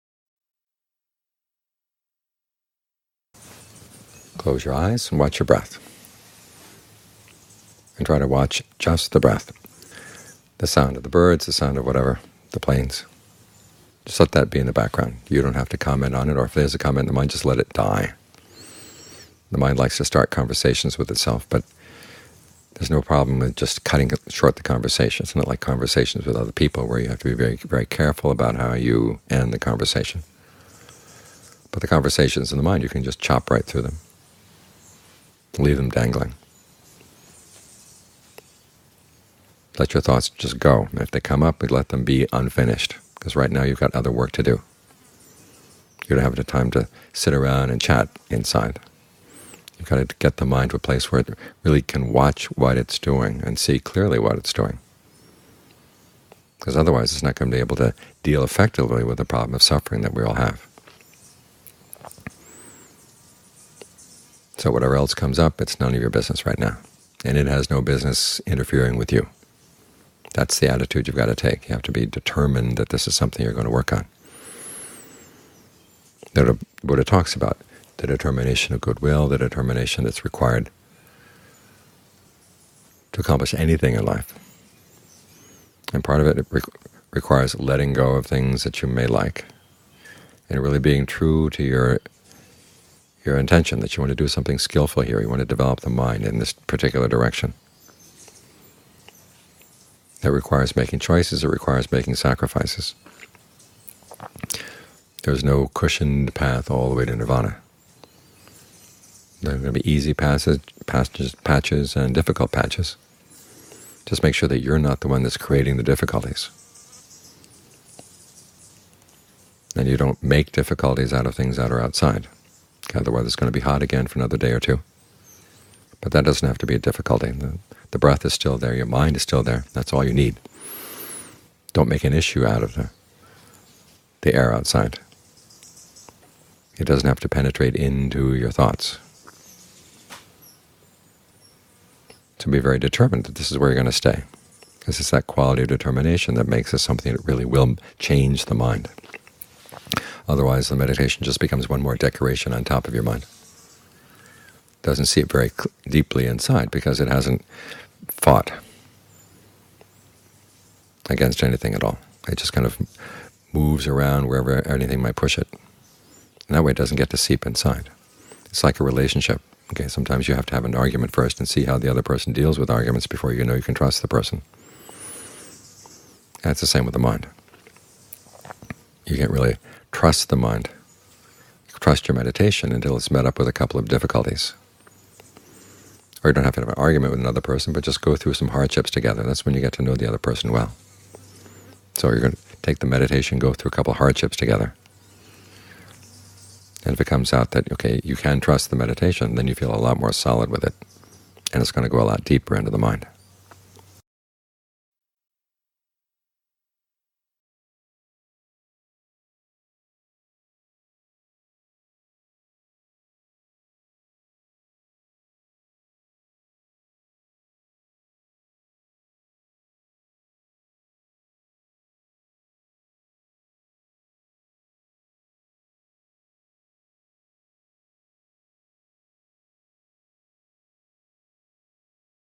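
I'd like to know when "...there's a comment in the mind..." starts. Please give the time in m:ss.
0:16.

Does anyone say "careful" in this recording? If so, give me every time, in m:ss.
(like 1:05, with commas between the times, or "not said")
0:27.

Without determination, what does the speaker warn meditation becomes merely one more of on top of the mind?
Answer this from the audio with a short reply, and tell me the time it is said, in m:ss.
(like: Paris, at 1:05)
decoration, at 2:31.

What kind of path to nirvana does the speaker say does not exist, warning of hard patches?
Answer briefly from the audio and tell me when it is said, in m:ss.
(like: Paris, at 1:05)
cushioned path, at 1:45.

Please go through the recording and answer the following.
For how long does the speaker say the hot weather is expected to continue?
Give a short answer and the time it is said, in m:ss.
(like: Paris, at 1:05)
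another day or two, at 2:04.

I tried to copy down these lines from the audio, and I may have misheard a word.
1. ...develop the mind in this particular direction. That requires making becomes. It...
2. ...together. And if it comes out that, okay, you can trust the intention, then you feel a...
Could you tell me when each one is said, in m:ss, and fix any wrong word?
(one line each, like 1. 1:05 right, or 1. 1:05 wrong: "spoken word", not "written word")
1. 1:35 wrong: "choices", not "becomes"
2. 3:14 wrong: "meditation", not "intention".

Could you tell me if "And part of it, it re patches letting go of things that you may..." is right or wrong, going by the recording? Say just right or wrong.
wrong.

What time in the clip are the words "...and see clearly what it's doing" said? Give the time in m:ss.
0:53.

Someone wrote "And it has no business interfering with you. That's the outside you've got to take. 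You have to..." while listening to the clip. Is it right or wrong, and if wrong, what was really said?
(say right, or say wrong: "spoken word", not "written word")
wrong: "attitude", not "outside".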